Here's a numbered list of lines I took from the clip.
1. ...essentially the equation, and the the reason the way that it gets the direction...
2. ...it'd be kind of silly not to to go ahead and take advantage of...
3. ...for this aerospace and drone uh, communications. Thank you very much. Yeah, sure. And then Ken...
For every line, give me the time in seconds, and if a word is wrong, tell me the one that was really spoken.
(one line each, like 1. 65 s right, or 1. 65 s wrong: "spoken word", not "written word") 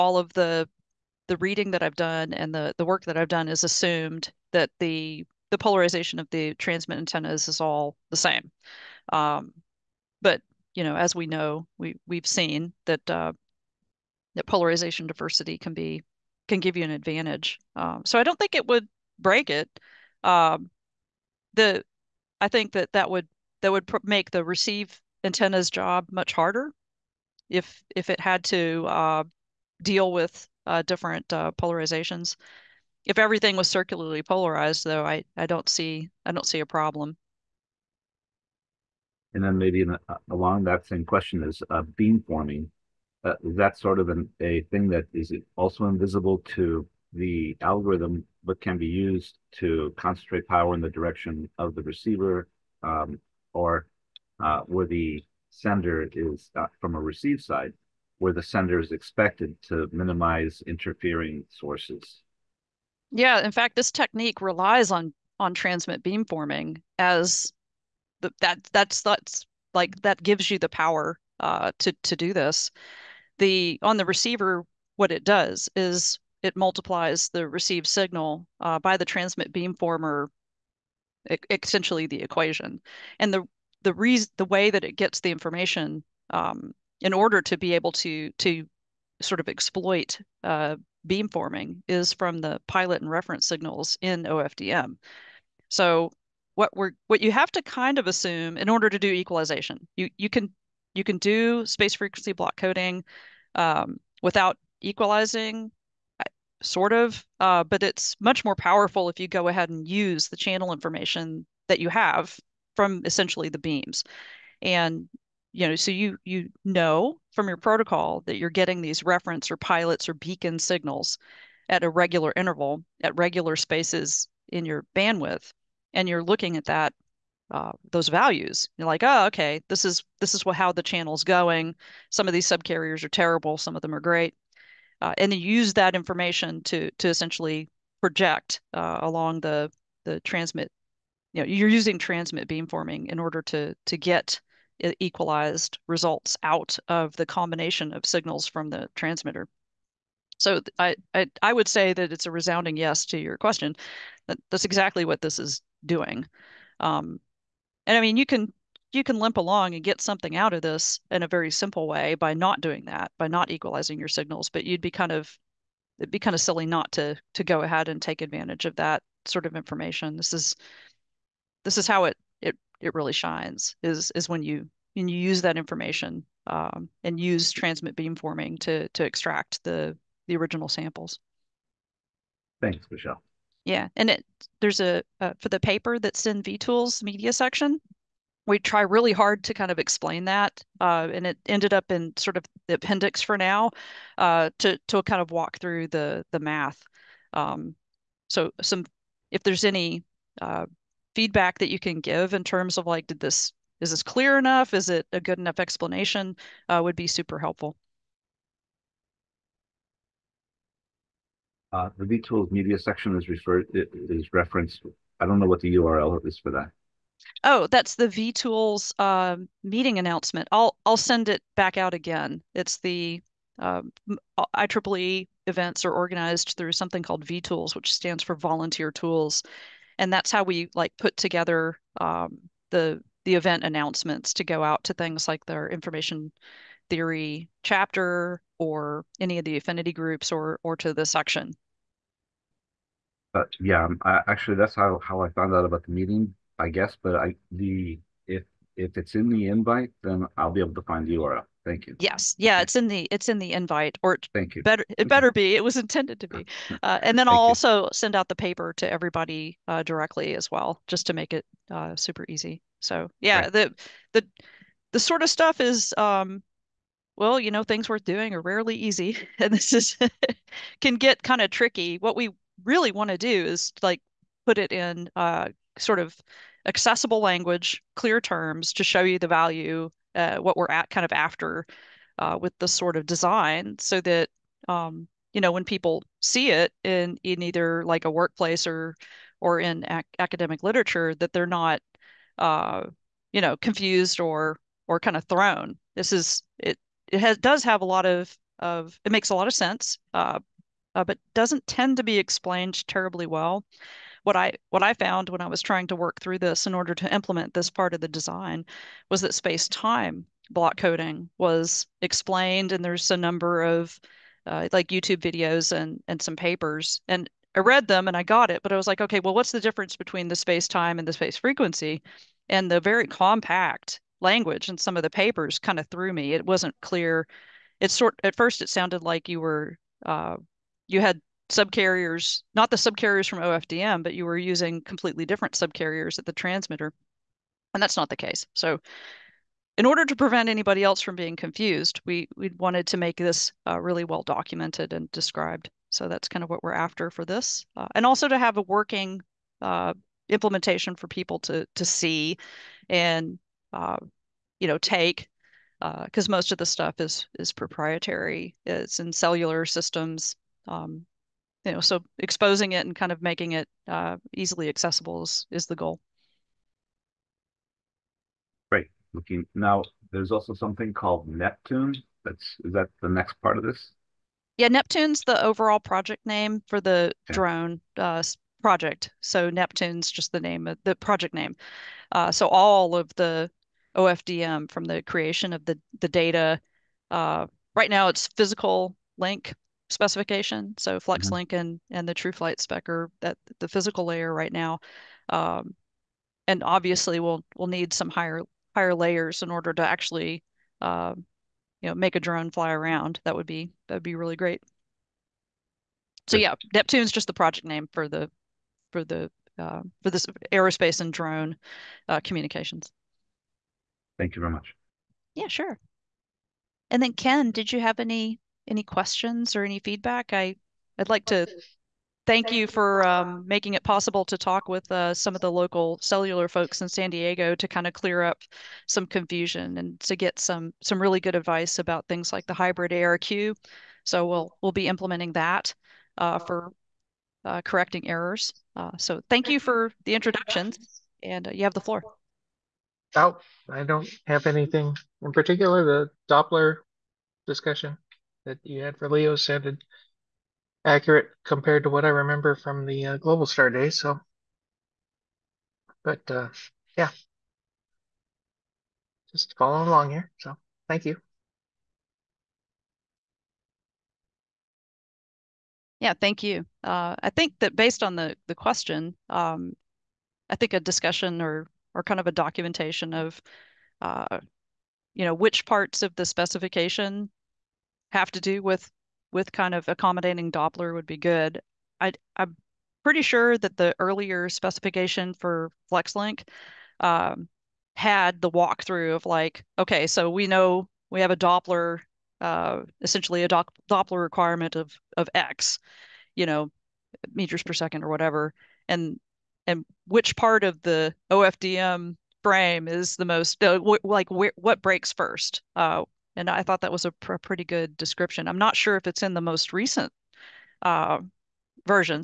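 1. 81 s wrong: "information", not "direction"
2. 165 s right
3. 410 s right.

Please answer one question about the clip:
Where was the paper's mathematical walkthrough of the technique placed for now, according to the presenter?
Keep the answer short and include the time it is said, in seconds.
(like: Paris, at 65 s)
the appendix, at 192 s.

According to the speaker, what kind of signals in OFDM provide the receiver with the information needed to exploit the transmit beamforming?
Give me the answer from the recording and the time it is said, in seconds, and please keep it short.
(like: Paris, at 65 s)
pilot and reference signals, at 92 s.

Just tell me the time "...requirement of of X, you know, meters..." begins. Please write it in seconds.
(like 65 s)
494 s.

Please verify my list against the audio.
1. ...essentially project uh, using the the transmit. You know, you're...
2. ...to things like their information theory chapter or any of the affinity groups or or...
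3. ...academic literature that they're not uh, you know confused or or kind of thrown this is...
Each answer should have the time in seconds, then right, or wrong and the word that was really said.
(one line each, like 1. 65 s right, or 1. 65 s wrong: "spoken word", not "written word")
1. 137 s wrong: "along", not "using"
2. 234 s right
3. 290 s right.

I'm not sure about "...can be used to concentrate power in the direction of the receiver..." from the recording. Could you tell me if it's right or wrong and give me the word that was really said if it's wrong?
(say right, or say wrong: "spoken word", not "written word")
right.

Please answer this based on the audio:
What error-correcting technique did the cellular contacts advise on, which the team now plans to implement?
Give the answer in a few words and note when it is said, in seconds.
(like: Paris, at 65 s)
hybrid ARQ, at 432 s.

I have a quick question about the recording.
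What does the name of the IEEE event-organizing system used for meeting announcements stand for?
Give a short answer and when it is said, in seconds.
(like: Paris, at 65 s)
Volunteer Tools, at 228 s.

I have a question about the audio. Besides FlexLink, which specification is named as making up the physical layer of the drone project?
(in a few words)
TrueFlight.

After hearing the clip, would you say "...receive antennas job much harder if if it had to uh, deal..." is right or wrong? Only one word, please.
right.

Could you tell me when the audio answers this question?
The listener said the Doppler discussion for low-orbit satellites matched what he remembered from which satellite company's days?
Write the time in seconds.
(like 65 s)
453 s.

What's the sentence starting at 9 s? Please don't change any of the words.
Um, but you know, as we know, we we've seen that uh, that polarization diversity can be can give you an advantage.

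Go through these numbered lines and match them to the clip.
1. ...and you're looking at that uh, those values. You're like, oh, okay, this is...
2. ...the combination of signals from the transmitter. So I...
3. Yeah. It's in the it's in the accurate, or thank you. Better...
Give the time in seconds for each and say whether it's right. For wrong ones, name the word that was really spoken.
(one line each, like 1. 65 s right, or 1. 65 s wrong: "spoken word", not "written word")
1. 125 s right
2. 147 s right
3. 252 s wrong: "invite", not "accurate".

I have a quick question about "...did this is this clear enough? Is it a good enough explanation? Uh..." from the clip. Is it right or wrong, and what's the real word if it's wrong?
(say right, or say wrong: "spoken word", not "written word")
right.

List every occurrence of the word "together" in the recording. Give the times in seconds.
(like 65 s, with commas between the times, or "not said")
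231 s.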